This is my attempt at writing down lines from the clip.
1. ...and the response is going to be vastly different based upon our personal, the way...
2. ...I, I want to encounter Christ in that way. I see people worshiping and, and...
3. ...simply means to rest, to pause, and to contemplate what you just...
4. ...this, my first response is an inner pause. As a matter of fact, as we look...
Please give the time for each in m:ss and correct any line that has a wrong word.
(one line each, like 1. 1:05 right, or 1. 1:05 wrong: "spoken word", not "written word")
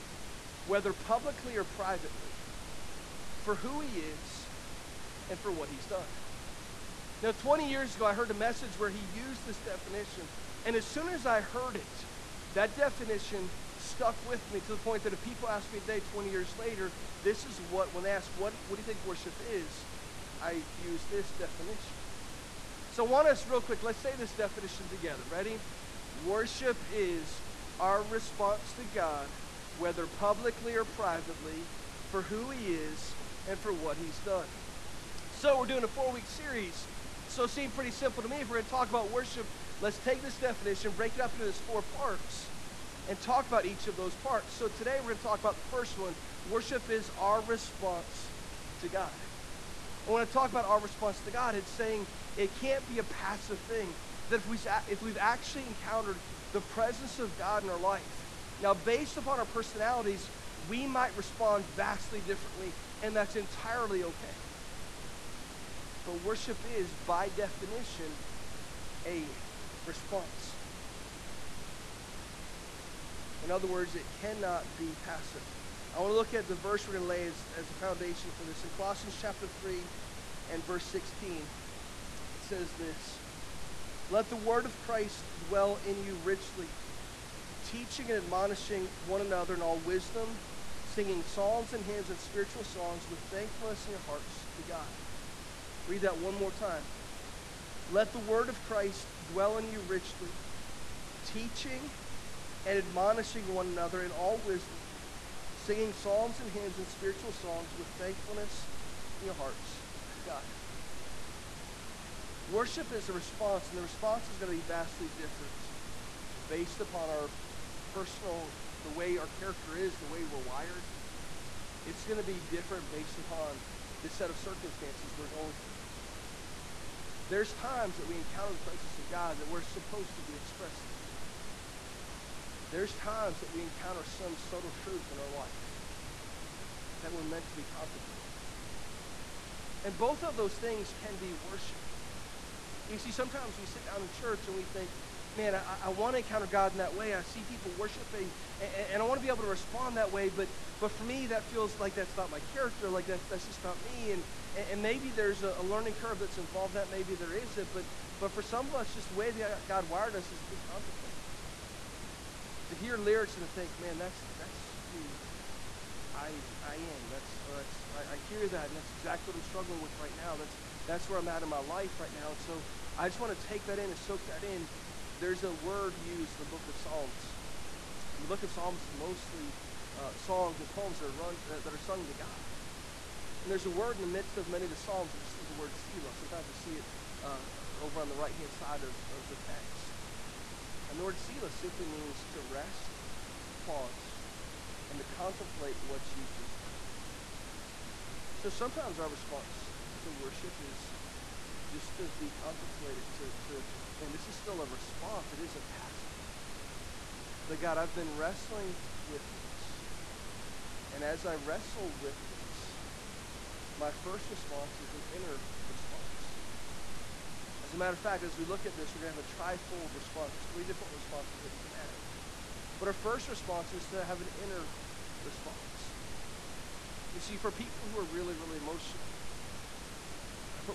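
1. 1:53 right
2. 2:25 wrong: "God", not "Christ"
3. 3:11 right
4. 3:32 wrong: "response", not "pause".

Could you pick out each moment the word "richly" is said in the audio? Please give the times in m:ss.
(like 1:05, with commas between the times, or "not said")
1:26, 1:39.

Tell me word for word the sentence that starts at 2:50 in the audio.
That's, that's where I'm at in my life right now.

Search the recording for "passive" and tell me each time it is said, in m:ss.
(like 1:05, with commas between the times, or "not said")
0:53, 1:14, 3:25.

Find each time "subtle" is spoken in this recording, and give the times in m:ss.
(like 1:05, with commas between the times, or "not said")
2:14.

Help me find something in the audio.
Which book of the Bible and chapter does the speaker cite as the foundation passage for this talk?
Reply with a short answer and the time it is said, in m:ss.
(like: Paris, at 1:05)
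Colossians 3, at 1:18.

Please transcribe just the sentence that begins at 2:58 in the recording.
And the book of Psalms is mostly uh, songs and poems that are, run, uh, that are sung to God.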